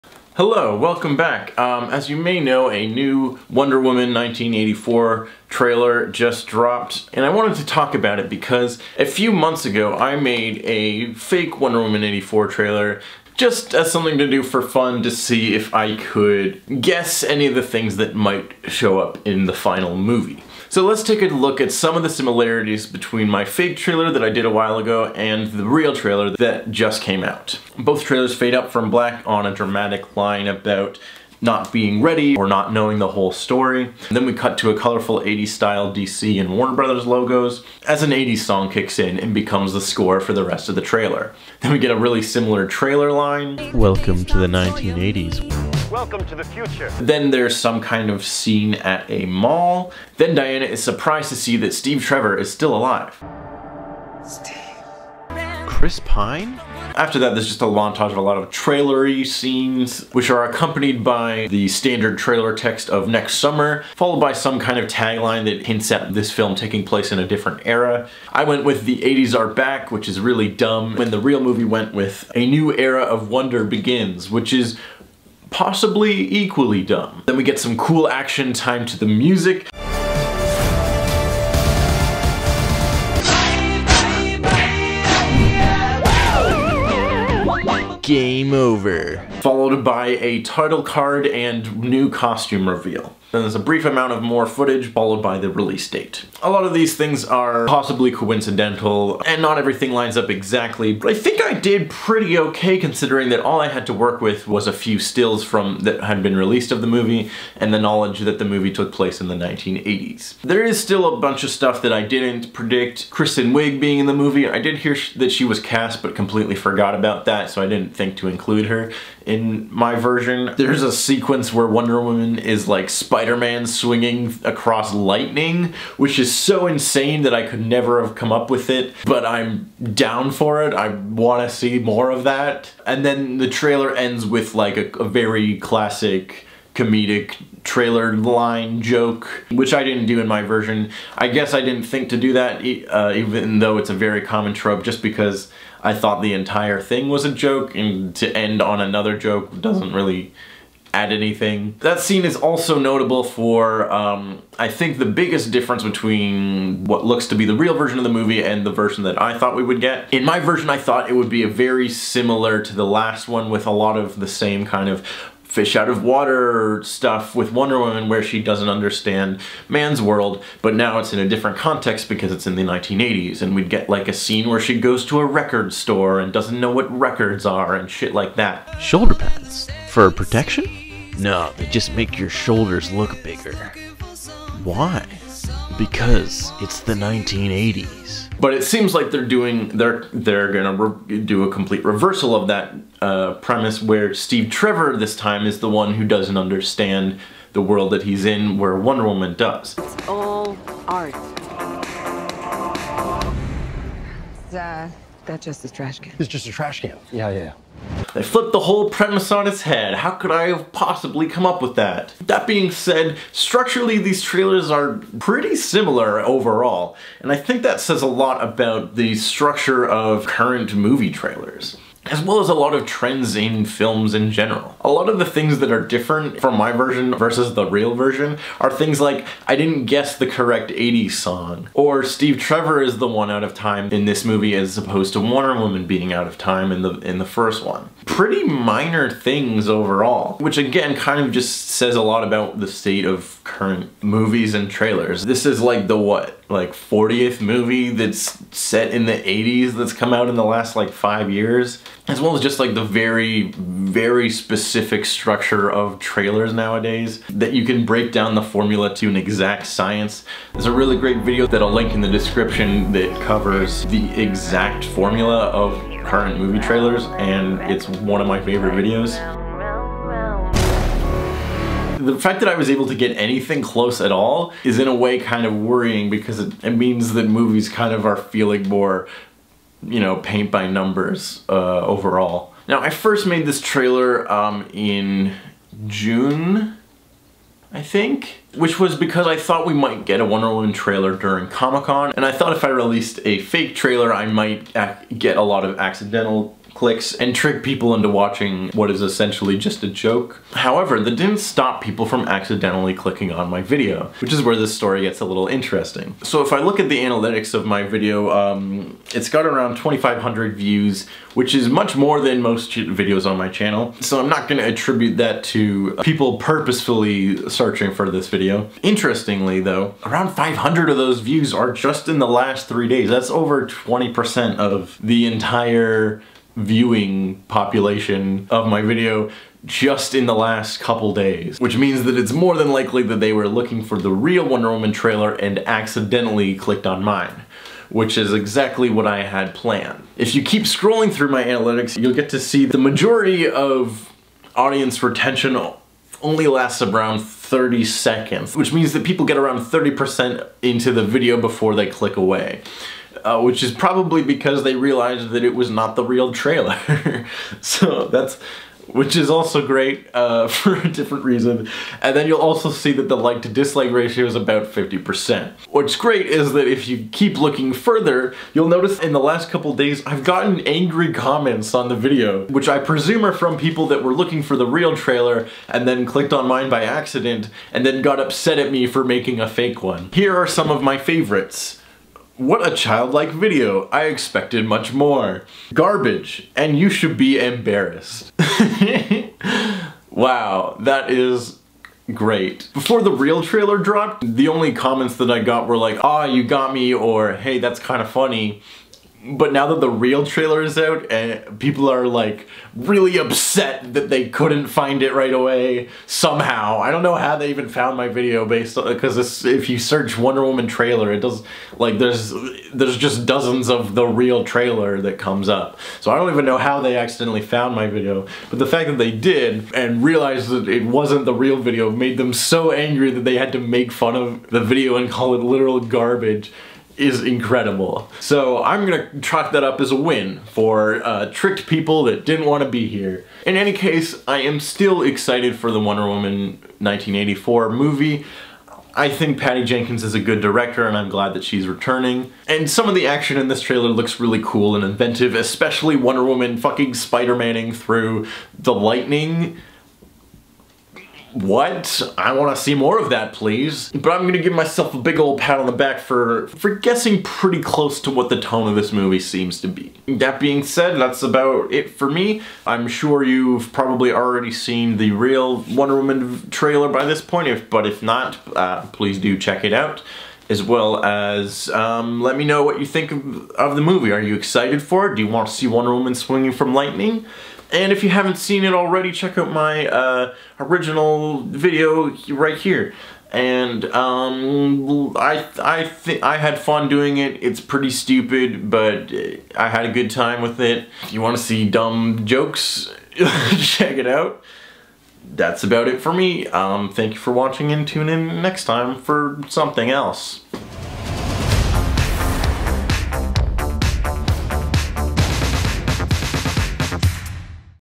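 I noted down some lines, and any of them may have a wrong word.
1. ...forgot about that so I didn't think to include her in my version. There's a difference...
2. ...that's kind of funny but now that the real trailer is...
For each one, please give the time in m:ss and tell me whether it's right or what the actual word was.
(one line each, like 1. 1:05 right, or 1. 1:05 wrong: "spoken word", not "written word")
1. 1:56 wrong: "sequence", not "difference"
2. 6:37 right.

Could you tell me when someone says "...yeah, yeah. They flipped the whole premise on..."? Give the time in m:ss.
3:27.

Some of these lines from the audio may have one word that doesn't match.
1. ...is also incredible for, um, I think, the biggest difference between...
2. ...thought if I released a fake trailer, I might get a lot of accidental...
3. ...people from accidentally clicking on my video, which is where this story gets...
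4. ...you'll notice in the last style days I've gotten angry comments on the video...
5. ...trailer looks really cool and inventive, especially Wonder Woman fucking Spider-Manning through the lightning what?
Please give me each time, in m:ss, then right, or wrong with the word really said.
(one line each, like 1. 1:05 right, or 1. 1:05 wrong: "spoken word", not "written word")
1. 2:32 wrong: "notable", not "incredible"
2. 4:52 right
3. 5:01 right
4. 6:08 wrong: "couple", not "style"
5. 7:23 right.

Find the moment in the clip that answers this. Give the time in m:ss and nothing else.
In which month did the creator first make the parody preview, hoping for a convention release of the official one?
4:45.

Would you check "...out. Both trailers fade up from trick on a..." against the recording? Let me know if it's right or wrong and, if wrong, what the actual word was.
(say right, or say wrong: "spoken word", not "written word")
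wrong: "black", not "trick".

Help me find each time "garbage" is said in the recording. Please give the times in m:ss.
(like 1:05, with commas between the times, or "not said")
6:25, 7:05.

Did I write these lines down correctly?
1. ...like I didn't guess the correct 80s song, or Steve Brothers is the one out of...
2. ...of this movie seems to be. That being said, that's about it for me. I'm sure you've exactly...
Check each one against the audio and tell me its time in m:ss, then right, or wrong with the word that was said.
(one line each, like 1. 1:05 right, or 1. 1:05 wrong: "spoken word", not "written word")
1. 3:48 wrong: "Trevor", not "Brothers"
2. 7:38 wrong: "probably", not "exactly".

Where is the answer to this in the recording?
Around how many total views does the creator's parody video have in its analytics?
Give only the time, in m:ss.
5:09.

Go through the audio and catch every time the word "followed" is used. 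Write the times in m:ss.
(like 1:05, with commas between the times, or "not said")
1:03, 1:29, 1:34.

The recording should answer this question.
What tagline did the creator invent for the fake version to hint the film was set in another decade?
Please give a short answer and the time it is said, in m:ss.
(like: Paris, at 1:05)
The 80s are back, at 1:08.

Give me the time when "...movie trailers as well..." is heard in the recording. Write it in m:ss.
3:40.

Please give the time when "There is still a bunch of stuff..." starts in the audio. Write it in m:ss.
1:50.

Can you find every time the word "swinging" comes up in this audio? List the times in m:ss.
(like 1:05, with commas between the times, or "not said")
2:03, 7:56.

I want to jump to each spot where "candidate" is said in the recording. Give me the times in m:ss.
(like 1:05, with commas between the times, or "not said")
not said.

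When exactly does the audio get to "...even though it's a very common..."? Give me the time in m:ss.
2:23.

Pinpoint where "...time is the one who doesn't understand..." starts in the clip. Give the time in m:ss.
3:15.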